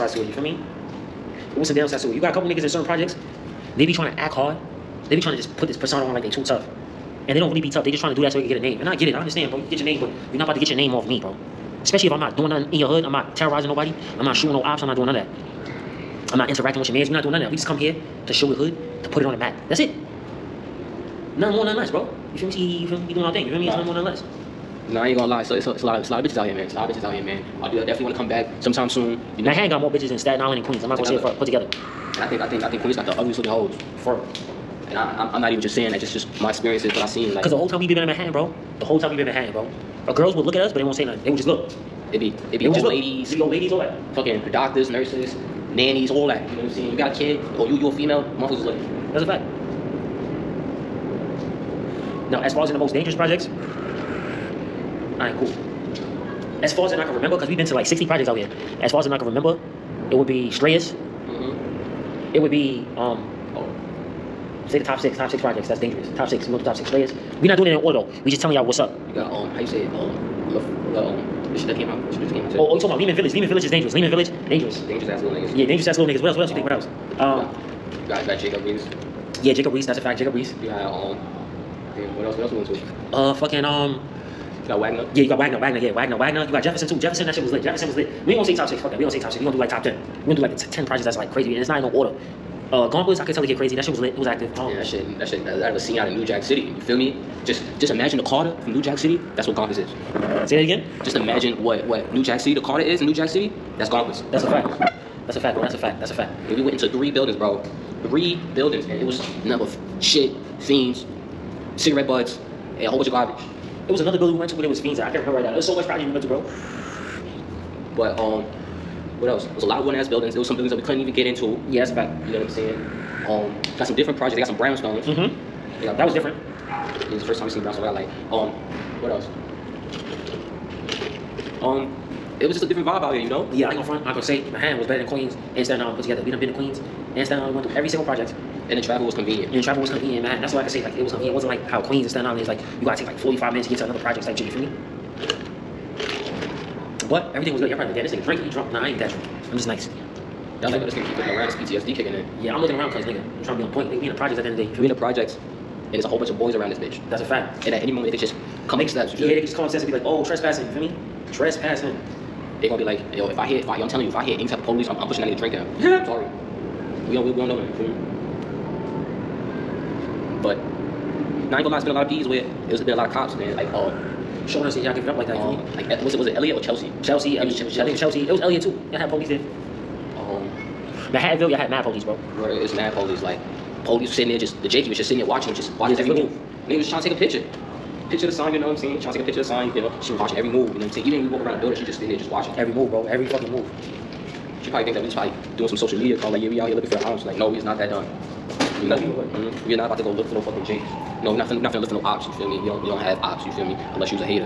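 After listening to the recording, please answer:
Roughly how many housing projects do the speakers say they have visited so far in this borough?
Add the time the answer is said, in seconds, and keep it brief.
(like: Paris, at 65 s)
60, at 57 s.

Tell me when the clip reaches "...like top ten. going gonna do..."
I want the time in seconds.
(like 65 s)
89 s.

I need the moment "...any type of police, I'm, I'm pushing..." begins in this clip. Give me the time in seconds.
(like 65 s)
164 s.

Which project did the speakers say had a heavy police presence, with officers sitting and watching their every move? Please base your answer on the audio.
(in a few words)
Manhattanville.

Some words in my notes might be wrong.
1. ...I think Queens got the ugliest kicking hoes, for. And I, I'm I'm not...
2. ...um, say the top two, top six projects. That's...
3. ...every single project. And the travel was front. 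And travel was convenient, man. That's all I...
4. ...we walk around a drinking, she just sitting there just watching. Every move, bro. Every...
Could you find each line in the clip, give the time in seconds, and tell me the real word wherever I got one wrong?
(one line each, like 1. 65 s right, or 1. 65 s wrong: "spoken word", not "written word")
1. 32 s wrong: "looking", not "kicking"
2. 62 s wrong: "six", not "two"
3. 137 s wrong: "convenient", not "front"
4. 191 s wrong: "building", not "drinking".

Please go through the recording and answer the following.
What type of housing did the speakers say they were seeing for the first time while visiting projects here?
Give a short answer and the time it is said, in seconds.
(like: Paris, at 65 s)
Brownstones, at 127 s.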